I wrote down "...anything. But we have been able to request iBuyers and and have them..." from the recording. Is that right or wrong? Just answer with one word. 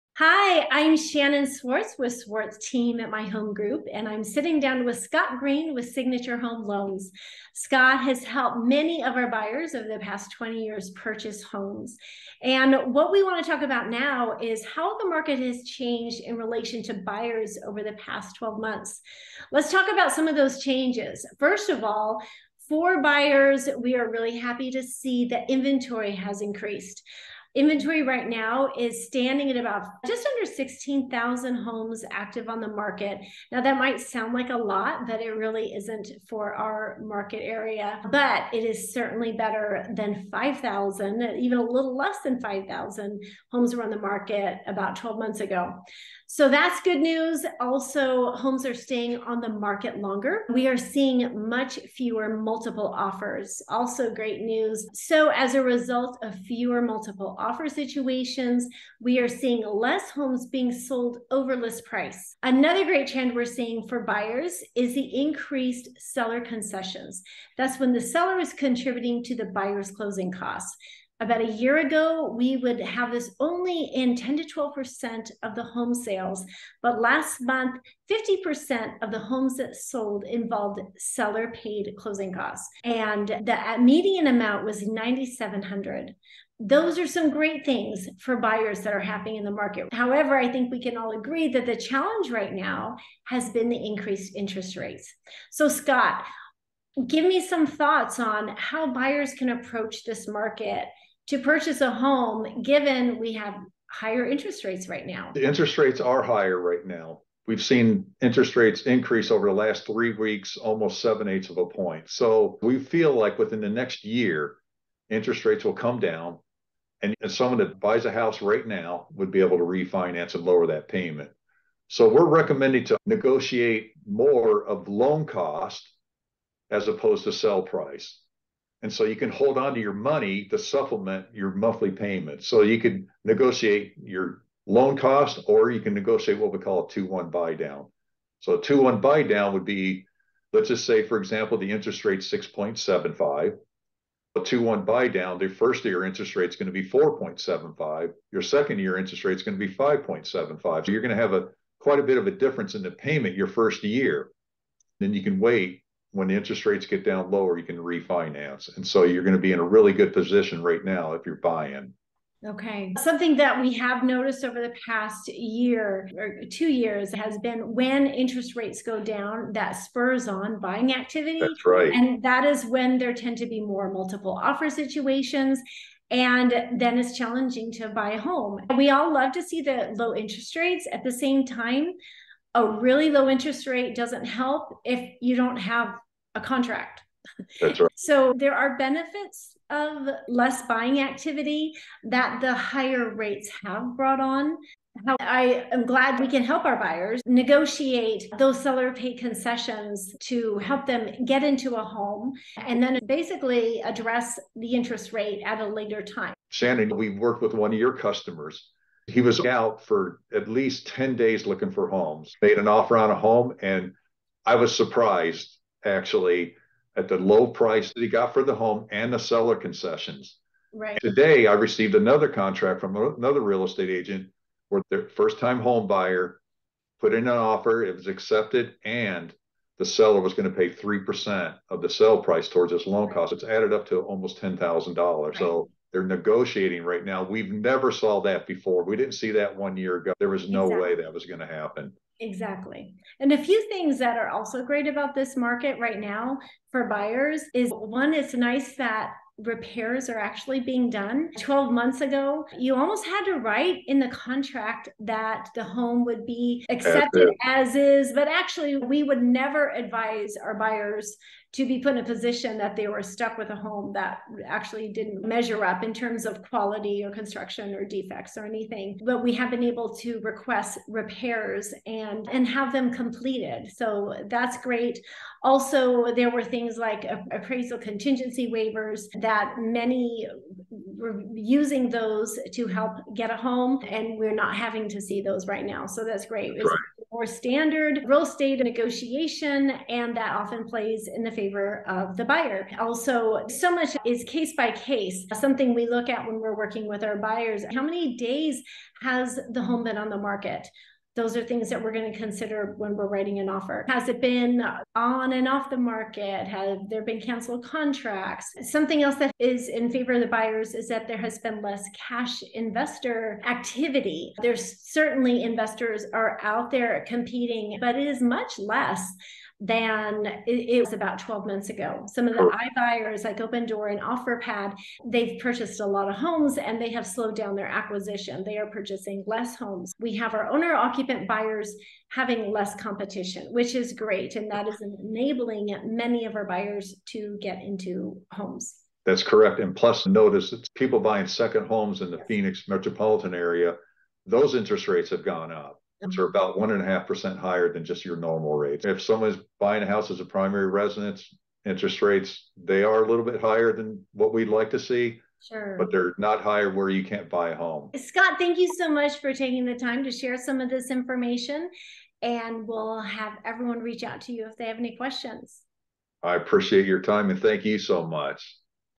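wrong.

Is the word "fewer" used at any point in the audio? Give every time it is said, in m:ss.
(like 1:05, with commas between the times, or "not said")
0:51, 0:56.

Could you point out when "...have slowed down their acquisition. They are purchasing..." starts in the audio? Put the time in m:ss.
5:26.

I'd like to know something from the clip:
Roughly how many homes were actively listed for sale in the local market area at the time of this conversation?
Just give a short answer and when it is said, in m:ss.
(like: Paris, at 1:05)
just under 16,000, at 0:30.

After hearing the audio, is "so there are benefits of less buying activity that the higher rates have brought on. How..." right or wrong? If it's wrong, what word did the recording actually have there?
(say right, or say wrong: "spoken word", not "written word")
right.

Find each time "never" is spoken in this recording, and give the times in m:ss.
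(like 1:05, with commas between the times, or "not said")
3:57, 4:19.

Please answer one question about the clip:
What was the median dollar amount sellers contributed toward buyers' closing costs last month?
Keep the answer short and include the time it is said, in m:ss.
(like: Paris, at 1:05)
9,700, at 1:24.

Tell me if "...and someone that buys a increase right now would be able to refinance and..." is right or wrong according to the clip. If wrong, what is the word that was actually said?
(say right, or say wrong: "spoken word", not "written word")
wrong: "house", not "increase".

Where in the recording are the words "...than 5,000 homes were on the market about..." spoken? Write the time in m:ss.
0:42.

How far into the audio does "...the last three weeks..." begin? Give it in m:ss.
1:49.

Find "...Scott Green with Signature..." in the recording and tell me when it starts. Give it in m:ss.
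0:04.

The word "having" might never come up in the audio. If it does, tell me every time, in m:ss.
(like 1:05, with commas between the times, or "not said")
4:44, 5:32.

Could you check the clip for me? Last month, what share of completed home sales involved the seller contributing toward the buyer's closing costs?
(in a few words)
50%.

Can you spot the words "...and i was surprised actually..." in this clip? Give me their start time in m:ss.
3:33.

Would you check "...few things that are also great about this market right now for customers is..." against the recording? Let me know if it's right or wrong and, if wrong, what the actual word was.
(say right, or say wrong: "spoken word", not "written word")
wrong: "buyers", not "customers".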